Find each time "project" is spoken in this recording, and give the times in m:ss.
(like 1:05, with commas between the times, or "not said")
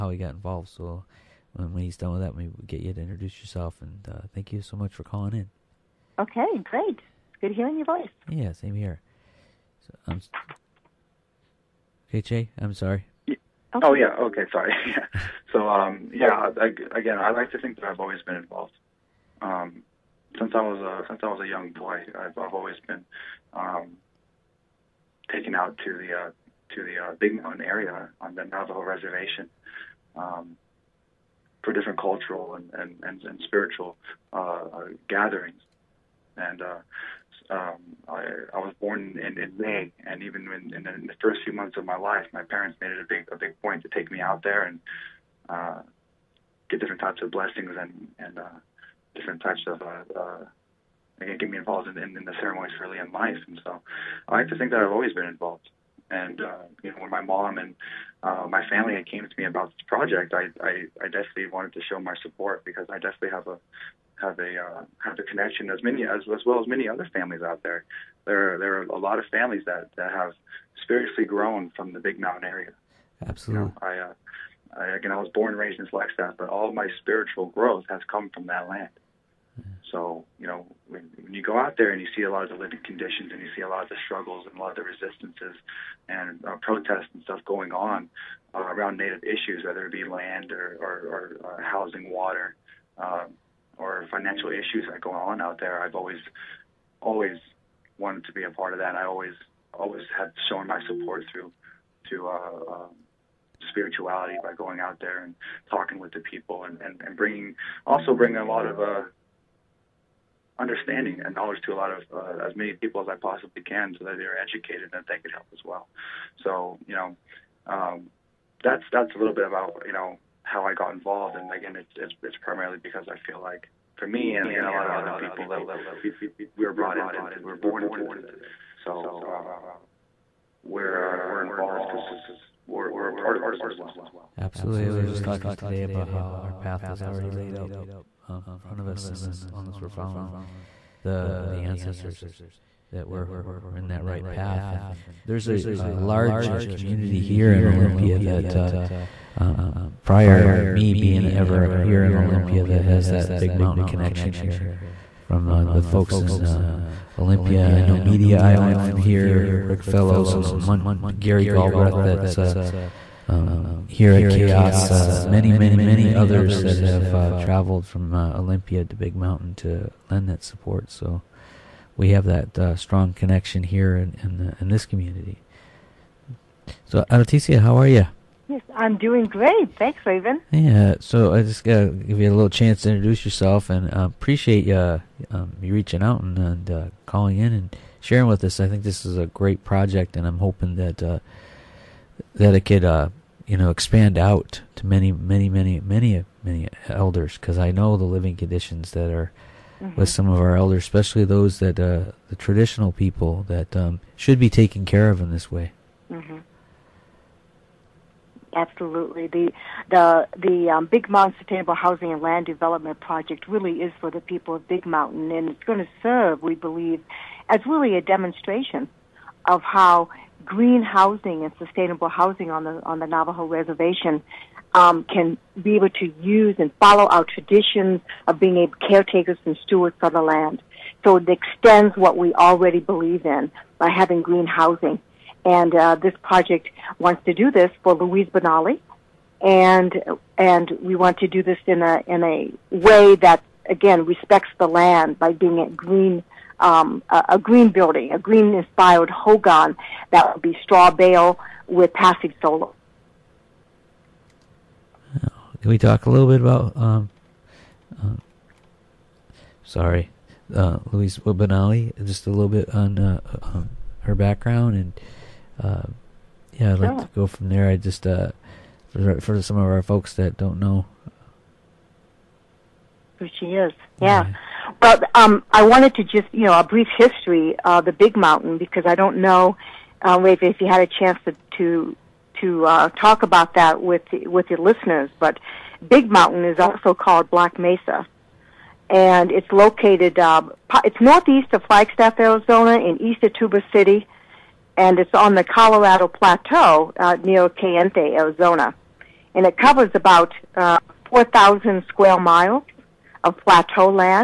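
0:59, 3:09, 3:33, 3:56.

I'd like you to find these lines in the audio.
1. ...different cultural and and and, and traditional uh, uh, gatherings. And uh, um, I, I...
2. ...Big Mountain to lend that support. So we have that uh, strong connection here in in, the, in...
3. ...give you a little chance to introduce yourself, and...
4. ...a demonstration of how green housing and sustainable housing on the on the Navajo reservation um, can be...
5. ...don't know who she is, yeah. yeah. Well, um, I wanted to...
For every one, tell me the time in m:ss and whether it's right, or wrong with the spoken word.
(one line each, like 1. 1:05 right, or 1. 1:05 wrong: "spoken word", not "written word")
1. 0:31 wrong: "spiritual", not "traditional"
2. 2:48 right
3. 3:01 right
4. 3:37 right
5. 4:30 right.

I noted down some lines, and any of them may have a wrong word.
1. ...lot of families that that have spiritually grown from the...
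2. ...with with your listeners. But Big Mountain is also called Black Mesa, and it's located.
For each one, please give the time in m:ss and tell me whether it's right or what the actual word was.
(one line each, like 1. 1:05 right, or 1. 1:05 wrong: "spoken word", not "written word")
1. 1:08 right
2. 4:43 right.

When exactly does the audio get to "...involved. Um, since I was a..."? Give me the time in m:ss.
0:18.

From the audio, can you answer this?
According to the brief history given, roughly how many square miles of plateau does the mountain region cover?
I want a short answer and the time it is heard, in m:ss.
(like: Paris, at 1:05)
4,000 square miles, at 5:01.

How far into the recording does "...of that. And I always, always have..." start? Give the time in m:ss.
1:38.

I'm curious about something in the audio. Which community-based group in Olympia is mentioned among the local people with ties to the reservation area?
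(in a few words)
Media Island.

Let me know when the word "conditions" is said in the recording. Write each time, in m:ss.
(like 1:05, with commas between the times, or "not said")
1:22, 3:18.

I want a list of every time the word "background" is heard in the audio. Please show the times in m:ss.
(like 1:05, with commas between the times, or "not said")
4:24.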